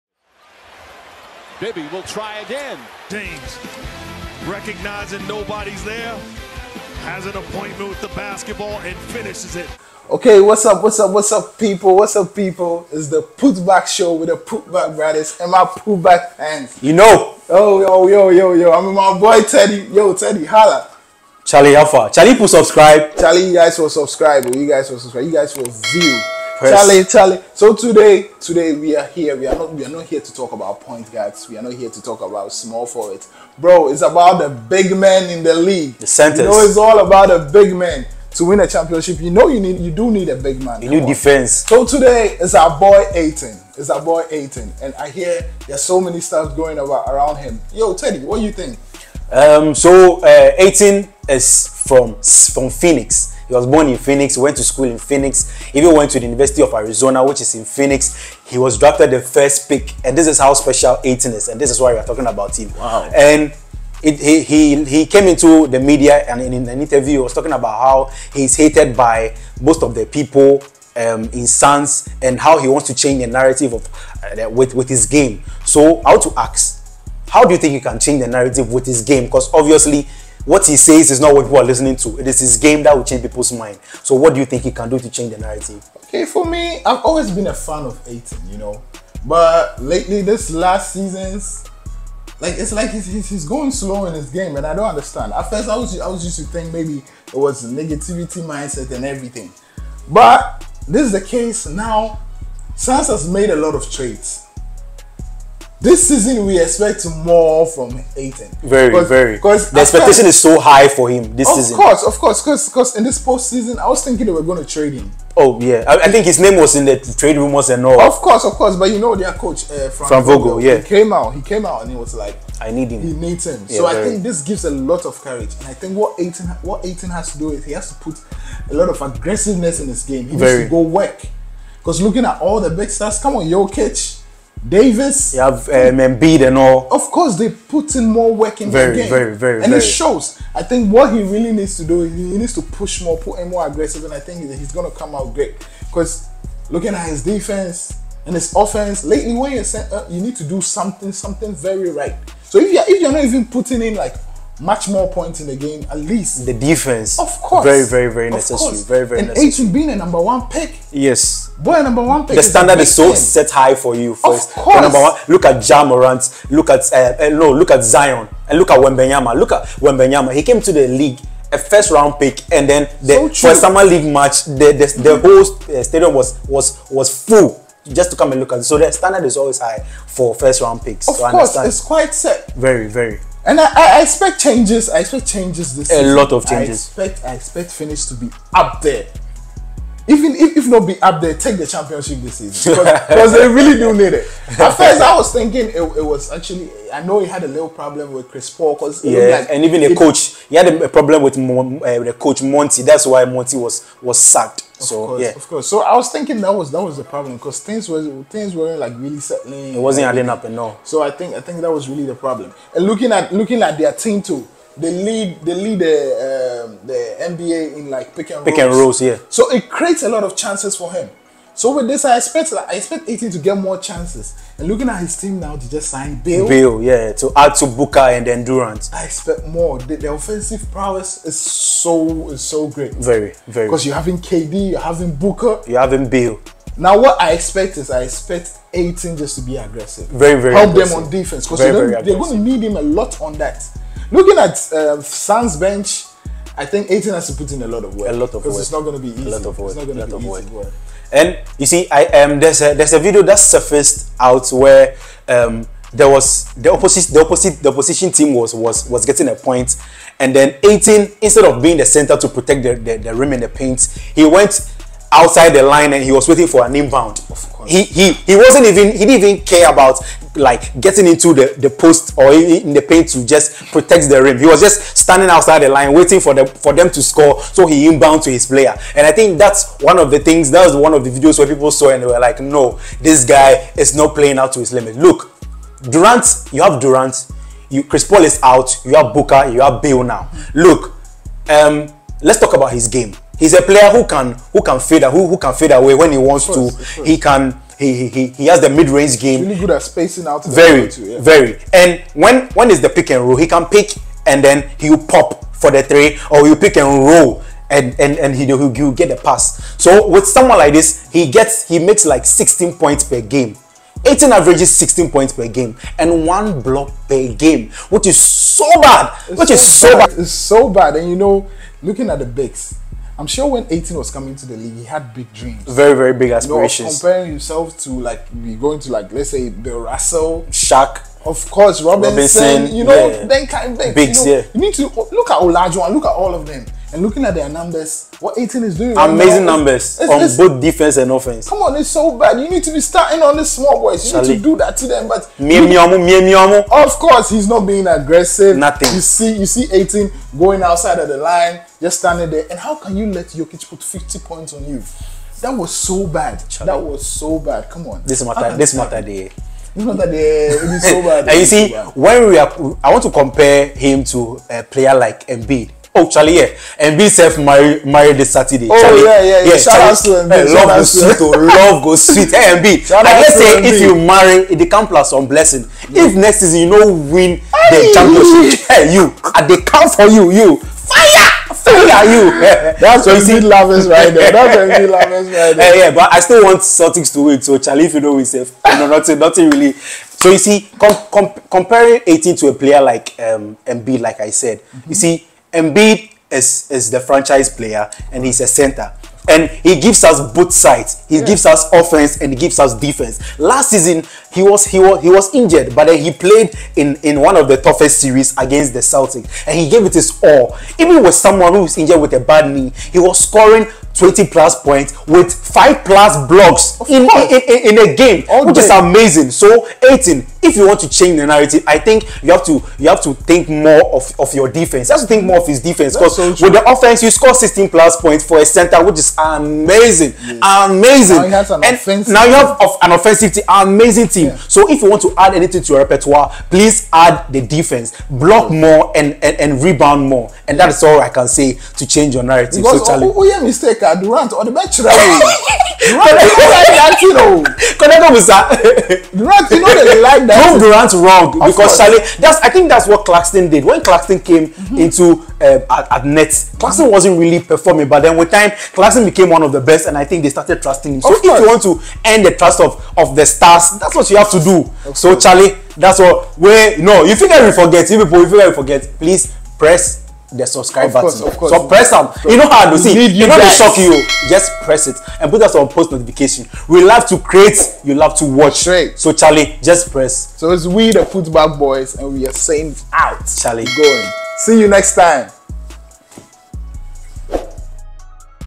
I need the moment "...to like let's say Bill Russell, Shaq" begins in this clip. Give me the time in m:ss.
5:28.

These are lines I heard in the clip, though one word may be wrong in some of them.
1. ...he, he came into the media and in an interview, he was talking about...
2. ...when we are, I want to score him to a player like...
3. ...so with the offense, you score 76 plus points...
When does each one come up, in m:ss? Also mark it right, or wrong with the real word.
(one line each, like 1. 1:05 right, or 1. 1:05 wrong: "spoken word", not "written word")
1. 1:04 right
2. 6:01 wrong: "compare", not "score"
3. 7:06 wrong: "16", not "76".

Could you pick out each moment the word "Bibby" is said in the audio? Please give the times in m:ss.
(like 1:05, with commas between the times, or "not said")
0:01.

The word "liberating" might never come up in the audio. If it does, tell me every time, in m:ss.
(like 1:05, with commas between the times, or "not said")
not said.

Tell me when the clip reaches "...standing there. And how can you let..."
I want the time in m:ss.
5:51.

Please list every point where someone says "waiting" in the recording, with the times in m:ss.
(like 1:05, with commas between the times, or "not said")
4:26, 4:35.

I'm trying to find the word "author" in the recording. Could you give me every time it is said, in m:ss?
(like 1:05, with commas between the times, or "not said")
not said.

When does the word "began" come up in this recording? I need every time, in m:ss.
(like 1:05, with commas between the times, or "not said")
not said.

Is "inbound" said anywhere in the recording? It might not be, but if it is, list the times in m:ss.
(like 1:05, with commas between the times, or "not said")
4:26, 4:37.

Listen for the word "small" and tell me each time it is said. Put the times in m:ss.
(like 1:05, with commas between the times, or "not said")
0:32, 5:43.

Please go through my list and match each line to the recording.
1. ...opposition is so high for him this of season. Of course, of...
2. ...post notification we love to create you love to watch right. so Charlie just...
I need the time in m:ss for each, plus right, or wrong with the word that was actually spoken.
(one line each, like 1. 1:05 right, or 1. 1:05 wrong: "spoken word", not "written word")
1. 1:49 wrong: "expectation", not "opposition"
2. 7:55 right.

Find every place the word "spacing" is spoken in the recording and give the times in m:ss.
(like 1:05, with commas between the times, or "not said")
4:59.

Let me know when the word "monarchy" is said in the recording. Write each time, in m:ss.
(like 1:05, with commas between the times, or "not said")
not said.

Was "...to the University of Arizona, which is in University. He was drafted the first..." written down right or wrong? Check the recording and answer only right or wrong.
wrong.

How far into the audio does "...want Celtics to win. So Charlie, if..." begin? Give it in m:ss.
6:26.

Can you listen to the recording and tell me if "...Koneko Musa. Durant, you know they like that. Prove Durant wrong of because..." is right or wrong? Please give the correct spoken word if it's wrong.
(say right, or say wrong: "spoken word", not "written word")
right.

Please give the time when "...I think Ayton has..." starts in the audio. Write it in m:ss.
4:06.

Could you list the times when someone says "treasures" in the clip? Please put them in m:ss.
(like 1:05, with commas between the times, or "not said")
not said.